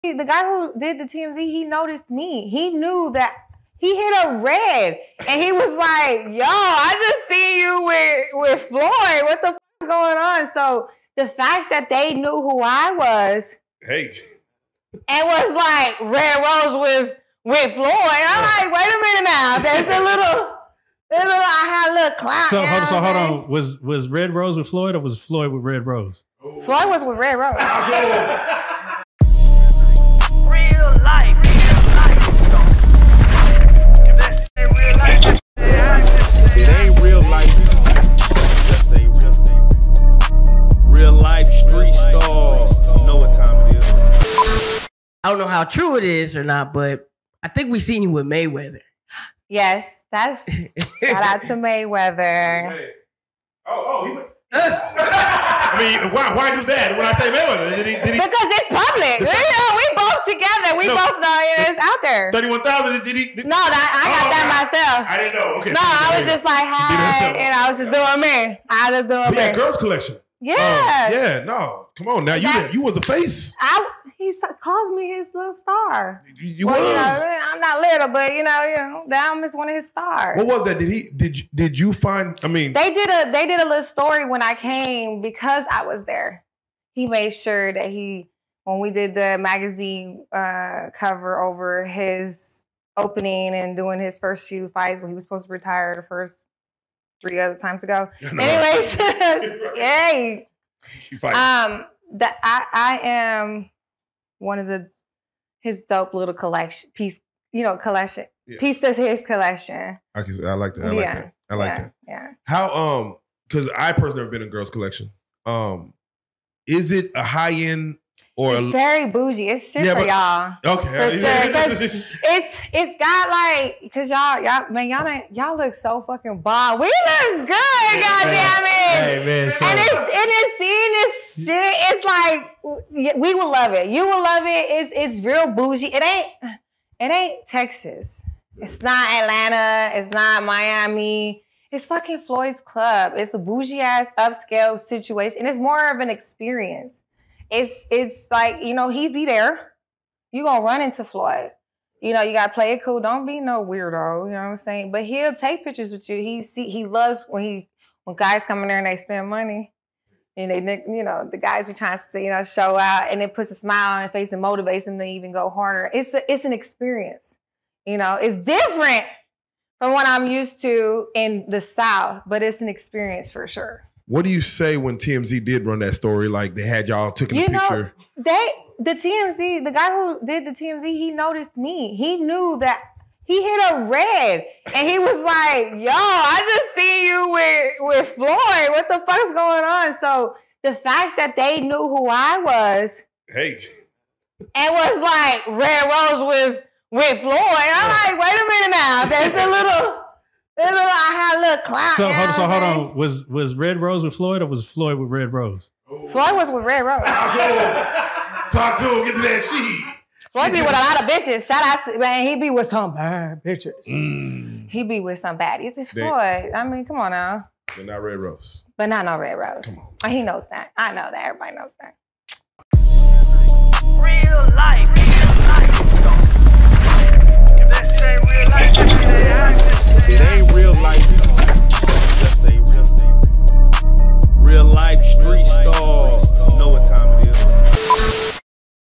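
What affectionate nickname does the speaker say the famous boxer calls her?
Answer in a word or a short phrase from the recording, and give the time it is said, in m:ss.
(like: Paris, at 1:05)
little star, at 1:15.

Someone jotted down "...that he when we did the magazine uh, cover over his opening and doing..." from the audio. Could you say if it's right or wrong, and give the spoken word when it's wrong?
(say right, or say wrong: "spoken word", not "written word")
right.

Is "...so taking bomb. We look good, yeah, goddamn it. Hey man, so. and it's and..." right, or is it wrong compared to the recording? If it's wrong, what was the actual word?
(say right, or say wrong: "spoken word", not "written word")
wrong: "fucking", not "taking".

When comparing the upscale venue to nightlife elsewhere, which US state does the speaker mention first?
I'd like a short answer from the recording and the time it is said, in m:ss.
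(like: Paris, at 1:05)
Texas, at 2:17.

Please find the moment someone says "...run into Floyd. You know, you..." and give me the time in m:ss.
2:30.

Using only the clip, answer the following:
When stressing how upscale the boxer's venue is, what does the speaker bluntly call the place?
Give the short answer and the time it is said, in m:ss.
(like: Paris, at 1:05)
Floyd's Club, at 2:22.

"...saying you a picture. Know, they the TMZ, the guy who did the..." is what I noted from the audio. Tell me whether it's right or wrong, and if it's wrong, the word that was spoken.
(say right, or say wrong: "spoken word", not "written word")
wrong: "taking", not "saying".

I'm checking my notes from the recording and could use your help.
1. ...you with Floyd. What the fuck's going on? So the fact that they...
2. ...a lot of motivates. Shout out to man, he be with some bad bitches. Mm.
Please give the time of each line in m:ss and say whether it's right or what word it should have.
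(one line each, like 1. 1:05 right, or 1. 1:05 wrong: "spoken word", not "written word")
1. 3:07 right
2. 3:30 wrong: "bitches", not "motivates".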